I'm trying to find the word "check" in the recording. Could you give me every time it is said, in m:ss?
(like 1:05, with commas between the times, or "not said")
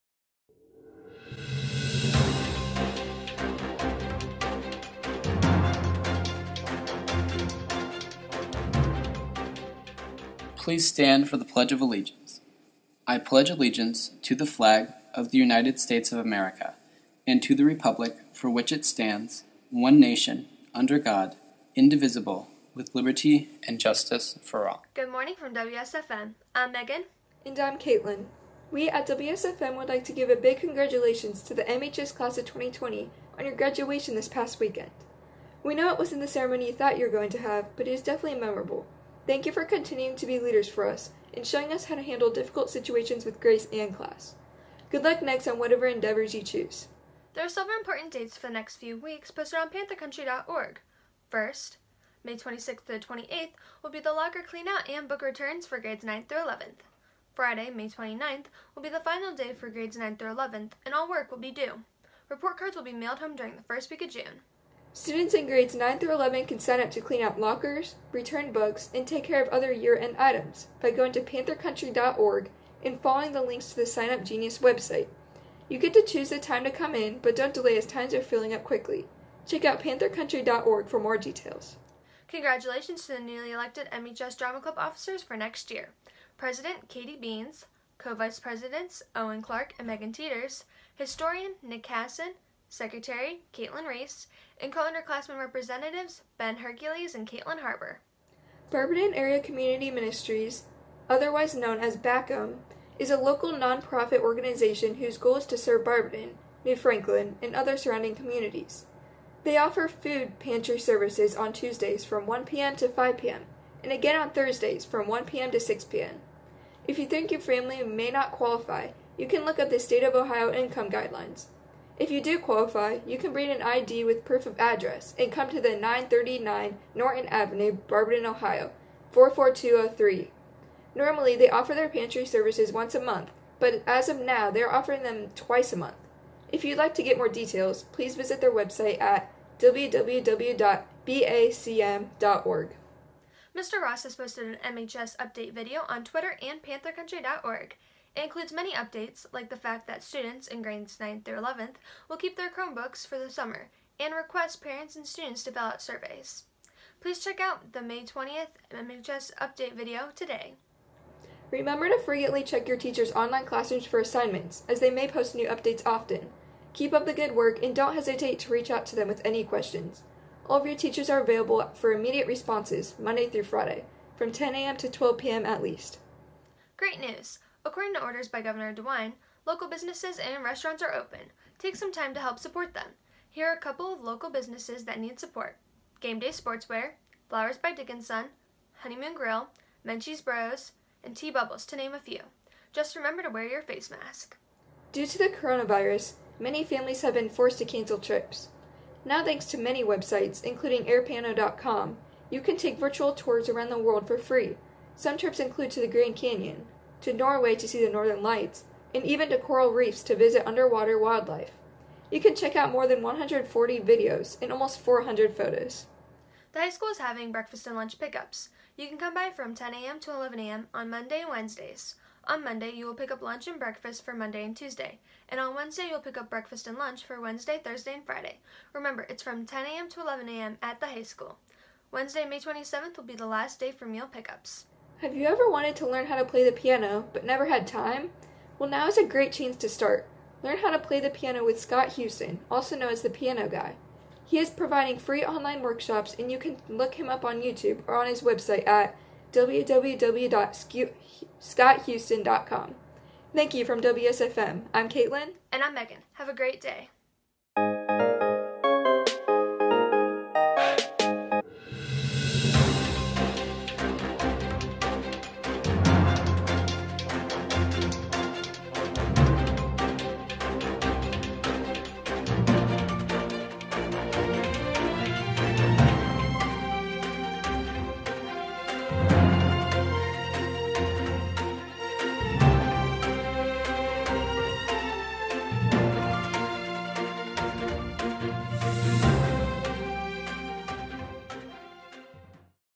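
1:19, 2:37, 2:42, 3:32.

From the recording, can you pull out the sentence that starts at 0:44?
Good luck next on whatever endeavors you choose.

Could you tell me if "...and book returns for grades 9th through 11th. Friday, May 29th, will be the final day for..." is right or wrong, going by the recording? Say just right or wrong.
right.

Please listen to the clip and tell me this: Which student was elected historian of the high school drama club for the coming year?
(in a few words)
Nick Casson.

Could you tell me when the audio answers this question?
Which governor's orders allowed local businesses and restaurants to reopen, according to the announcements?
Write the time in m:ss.
2:58.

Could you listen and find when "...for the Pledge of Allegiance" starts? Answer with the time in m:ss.
0:11.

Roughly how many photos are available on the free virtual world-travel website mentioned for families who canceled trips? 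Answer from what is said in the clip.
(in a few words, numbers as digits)
400.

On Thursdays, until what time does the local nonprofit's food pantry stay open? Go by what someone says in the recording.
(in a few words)
6 p.m.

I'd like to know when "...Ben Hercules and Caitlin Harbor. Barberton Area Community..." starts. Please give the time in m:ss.
1:36.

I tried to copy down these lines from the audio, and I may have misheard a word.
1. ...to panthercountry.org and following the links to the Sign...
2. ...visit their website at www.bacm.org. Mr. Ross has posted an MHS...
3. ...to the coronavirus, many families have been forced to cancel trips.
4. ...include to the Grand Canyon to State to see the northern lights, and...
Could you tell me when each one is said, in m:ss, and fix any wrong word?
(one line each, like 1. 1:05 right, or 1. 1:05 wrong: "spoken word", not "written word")
1. 1:11 right
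2. 2:18 right
3. 3:15 right
4. 3:25 wrong: "Norway", not "State".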